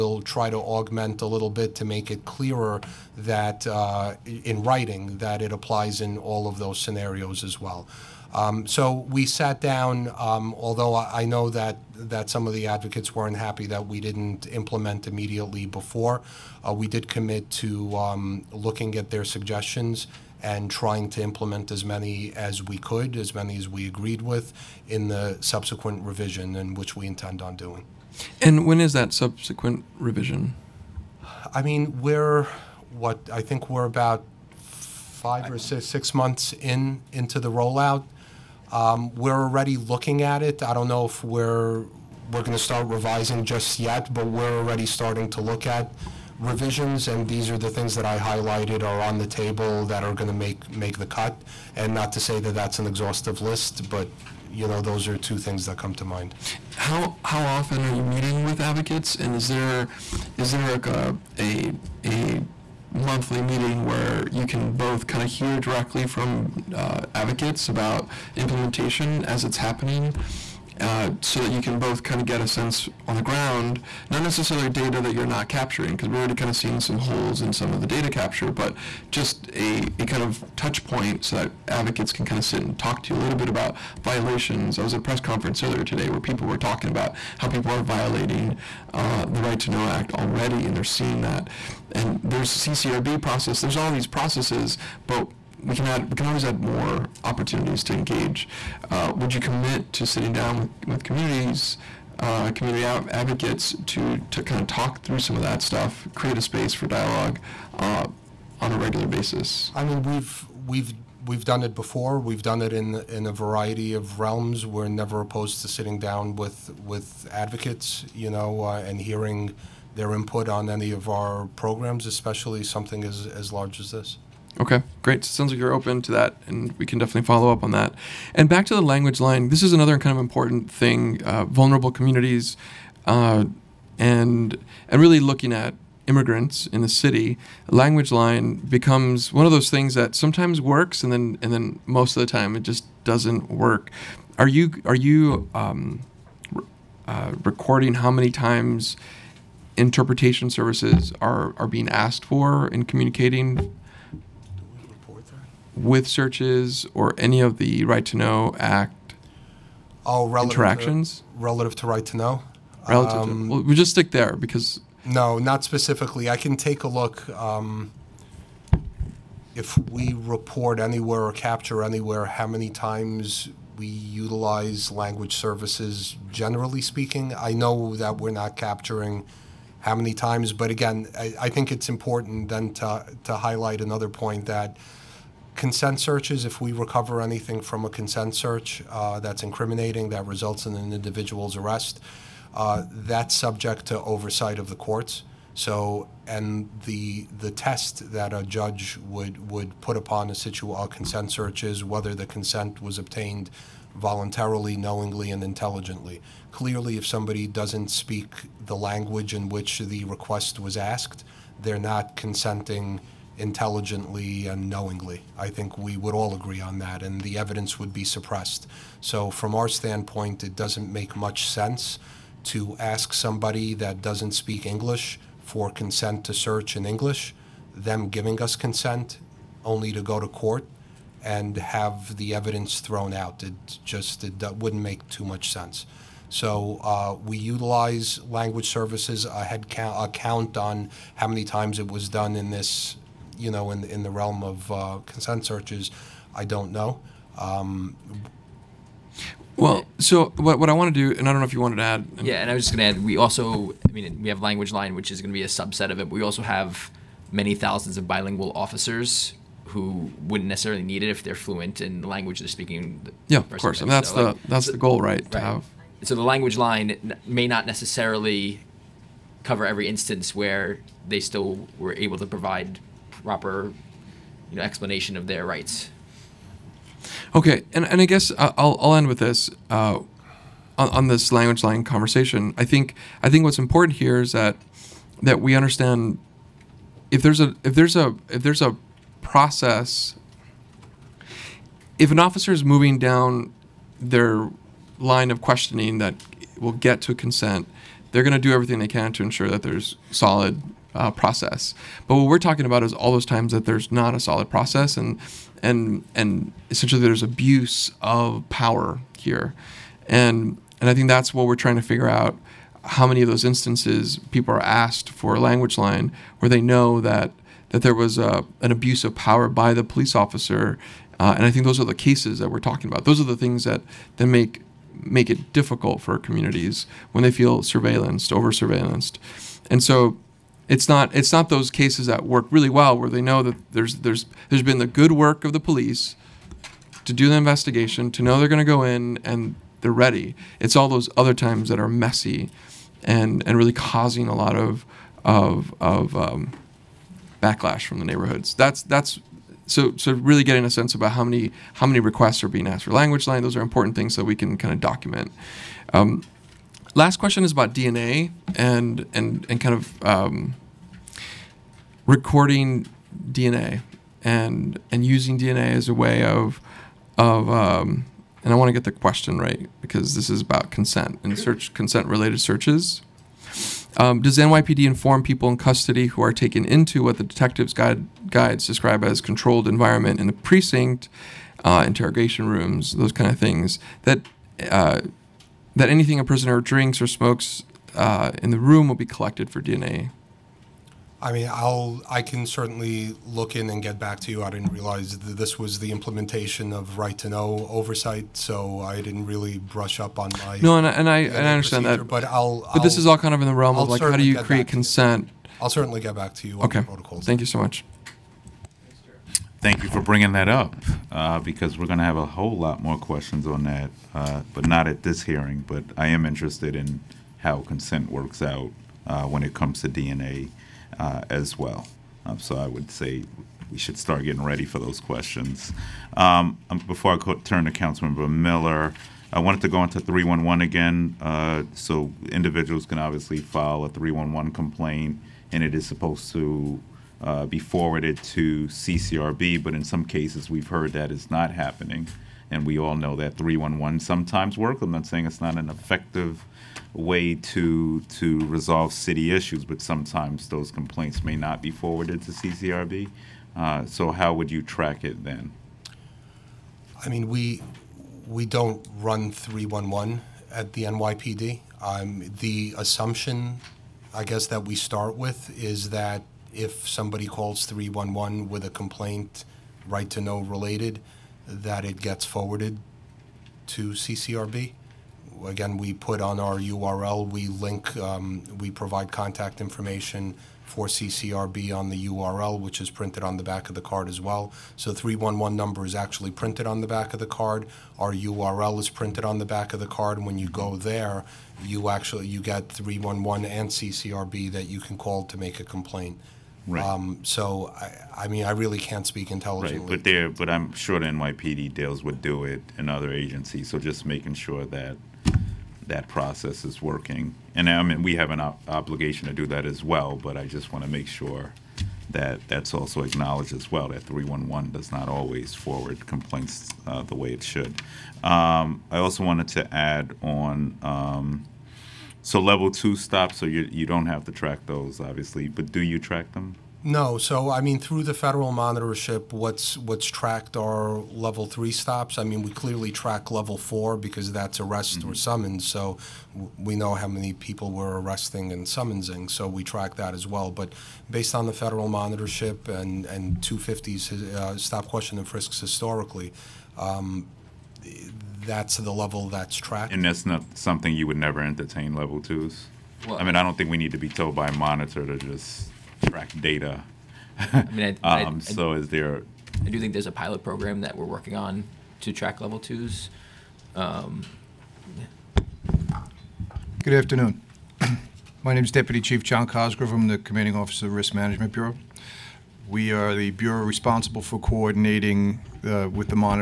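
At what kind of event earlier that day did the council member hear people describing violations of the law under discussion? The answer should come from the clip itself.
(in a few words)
press conference.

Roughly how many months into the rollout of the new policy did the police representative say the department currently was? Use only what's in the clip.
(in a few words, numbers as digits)
5 or 6 months.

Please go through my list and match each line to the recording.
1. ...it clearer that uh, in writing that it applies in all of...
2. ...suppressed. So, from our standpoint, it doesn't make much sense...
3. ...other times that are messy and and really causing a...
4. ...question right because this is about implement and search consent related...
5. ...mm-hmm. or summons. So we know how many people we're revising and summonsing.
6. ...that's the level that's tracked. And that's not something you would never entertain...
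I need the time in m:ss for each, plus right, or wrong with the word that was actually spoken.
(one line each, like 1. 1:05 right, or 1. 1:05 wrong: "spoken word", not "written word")
1. 0:02 right
2. 3:38 right
3. 5:41 right
4. 6:08 wrong: "consent", not "implement"
5. 8:54 wrong: "arresting", not "revising"
6. 9:08 right.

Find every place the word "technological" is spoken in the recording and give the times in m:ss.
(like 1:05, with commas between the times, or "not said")
not said.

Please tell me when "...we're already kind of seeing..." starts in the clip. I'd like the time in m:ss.
1:16.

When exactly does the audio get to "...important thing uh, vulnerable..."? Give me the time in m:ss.
2:10.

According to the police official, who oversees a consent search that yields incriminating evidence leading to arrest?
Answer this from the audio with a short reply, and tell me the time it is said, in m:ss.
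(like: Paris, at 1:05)
the courts, at 3:14.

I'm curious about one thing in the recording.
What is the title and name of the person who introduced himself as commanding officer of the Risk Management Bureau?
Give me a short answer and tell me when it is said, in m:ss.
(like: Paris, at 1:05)
Deputy Chief John Cosgrove, at 9:28.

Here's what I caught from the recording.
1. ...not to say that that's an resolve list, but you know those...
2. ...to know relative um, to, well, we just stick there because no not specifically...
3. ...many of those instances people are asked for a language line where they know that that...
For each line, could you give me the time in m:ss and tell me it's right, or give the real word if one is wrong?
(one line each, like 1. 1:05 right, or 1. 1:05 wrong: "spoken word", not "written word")
1. 0:51 wrong: "exhaustive", not "resolve"
2. 2:42 right
3. 5:13 right.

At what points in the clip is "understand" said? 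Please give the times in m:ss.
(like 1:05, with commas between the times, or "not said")
4:45, 6:41.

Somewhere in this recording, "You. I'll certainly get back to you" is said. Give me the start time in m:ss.
6:45.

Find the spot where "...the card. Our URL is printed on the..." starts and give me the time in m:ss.
8:07.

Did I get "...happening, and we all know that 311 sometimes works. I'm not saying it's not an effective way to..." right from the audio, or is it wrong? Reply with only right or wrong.
right.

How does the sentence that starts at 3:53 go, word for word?
It just it wouldn't make too much sense.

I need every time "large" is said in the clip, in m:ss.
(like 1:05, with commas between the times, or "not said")
2:03.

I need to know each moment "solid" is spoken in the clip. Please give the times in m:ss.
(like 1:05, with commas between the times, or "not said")
5:00, 5:04.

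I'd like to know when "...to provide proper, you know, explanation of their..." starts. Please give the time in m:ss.
4:32.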